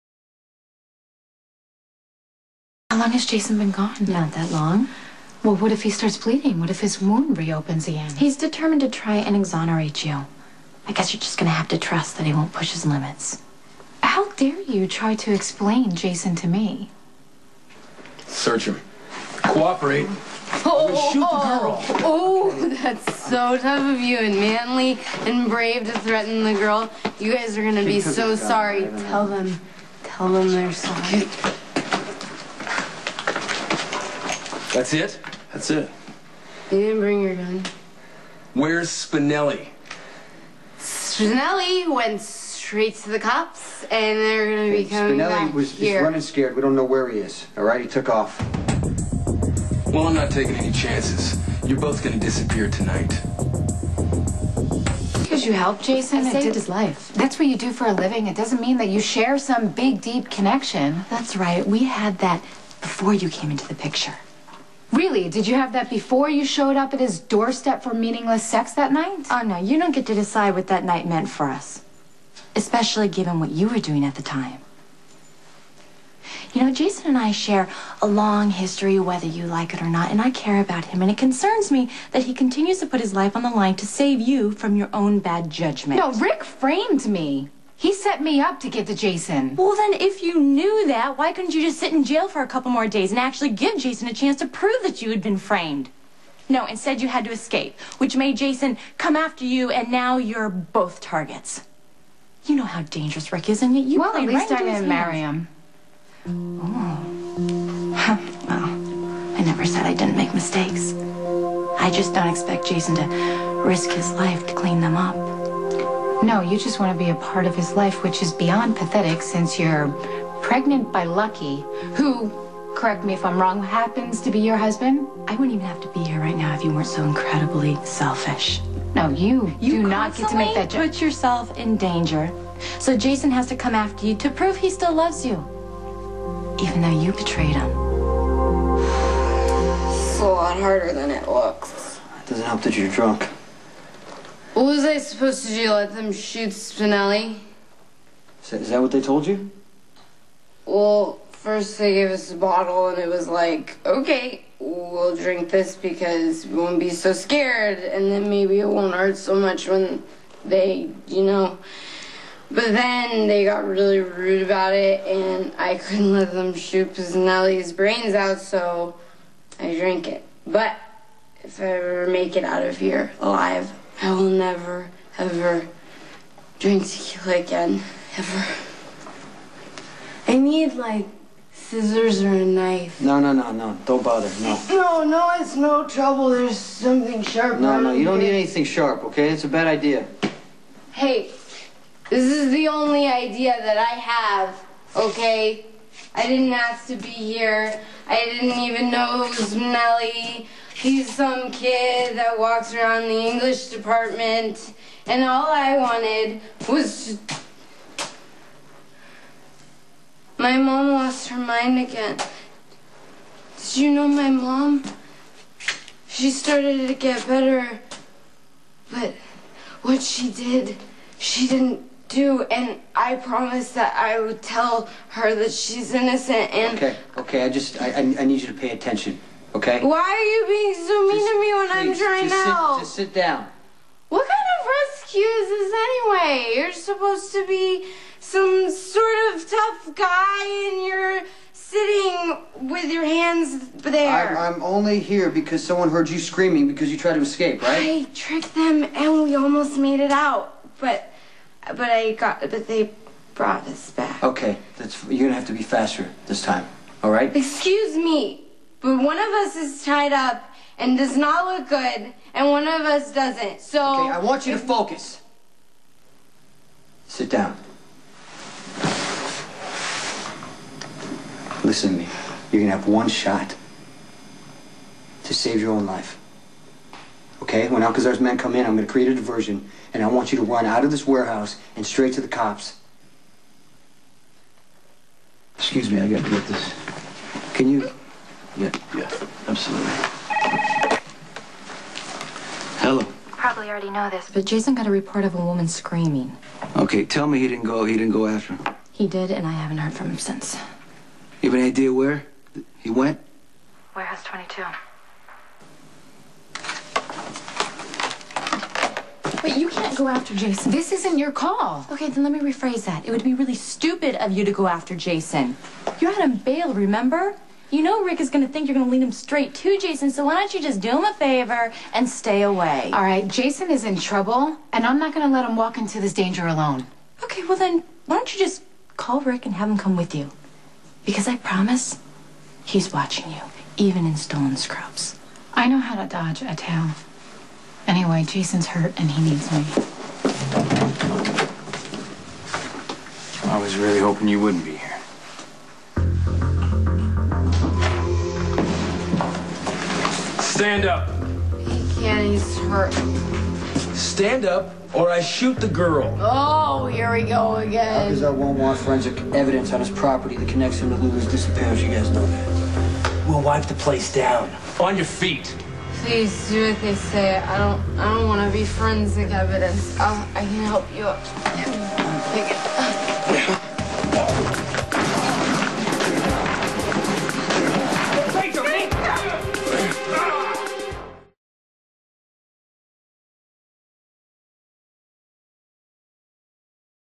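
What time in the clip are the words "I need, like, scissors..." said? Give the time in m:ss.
3:00.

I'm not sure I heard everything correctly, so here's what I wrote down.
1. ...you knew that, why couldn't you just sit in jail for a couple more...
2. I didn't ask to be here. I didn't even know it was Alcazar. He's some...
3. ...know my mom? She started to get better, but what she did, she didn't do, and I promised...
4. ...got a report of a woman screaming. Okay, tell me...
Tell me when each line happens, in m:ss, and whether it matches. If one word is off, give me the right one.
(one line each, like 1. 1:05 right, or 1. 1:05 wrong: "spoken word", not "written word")
1. 1:30 right
2. 3:16 wrong: "Melly", not "Alcazar"
3. 3:33 right
4. 4:54 right.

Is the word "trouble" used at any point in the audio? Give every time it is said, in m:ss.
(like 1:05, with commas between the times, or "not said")
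3:05, 5:23.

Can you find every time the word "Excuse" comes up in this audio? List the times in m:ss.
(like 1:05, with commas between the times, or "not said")
4:17, 4:45.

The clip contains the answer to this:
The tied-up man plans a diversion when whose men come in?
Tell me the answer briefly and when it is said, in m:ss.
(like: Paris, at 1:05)
Alcazar, at 4:37.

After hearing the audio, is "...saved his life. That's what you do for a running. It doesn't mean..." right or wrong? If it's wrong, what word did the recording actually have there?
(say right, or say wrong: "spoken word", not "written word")
wrong: "living", not "running".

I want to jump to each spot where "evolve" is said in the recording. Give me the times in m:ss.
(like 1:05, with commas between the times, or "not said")
not said.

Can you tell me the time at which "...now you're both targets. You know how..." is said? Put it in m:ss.
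1:39.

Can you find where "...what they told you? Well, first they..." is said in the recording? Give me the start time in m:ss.
2:28.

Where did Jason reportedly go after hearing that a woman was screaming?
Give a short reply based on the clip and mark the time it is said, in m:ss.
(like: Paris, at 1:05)
Warehouse 22, at 5:03.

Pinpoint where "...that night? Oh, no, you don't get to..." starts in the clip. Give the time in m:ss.
1:08.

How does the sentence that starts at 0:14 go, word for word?
How dare you try to explain Jason to me?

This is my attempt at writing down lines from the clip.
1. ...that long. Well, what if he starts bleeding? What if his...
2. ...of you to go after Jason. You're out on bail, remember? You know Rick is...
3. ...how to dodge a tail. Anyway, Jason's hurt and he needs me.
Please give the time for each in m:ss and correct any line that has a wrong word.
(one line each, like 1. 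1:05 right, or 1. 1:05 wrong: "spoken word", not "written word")
1. 0:04 right
2. 5:14 right
3. 5:35 right.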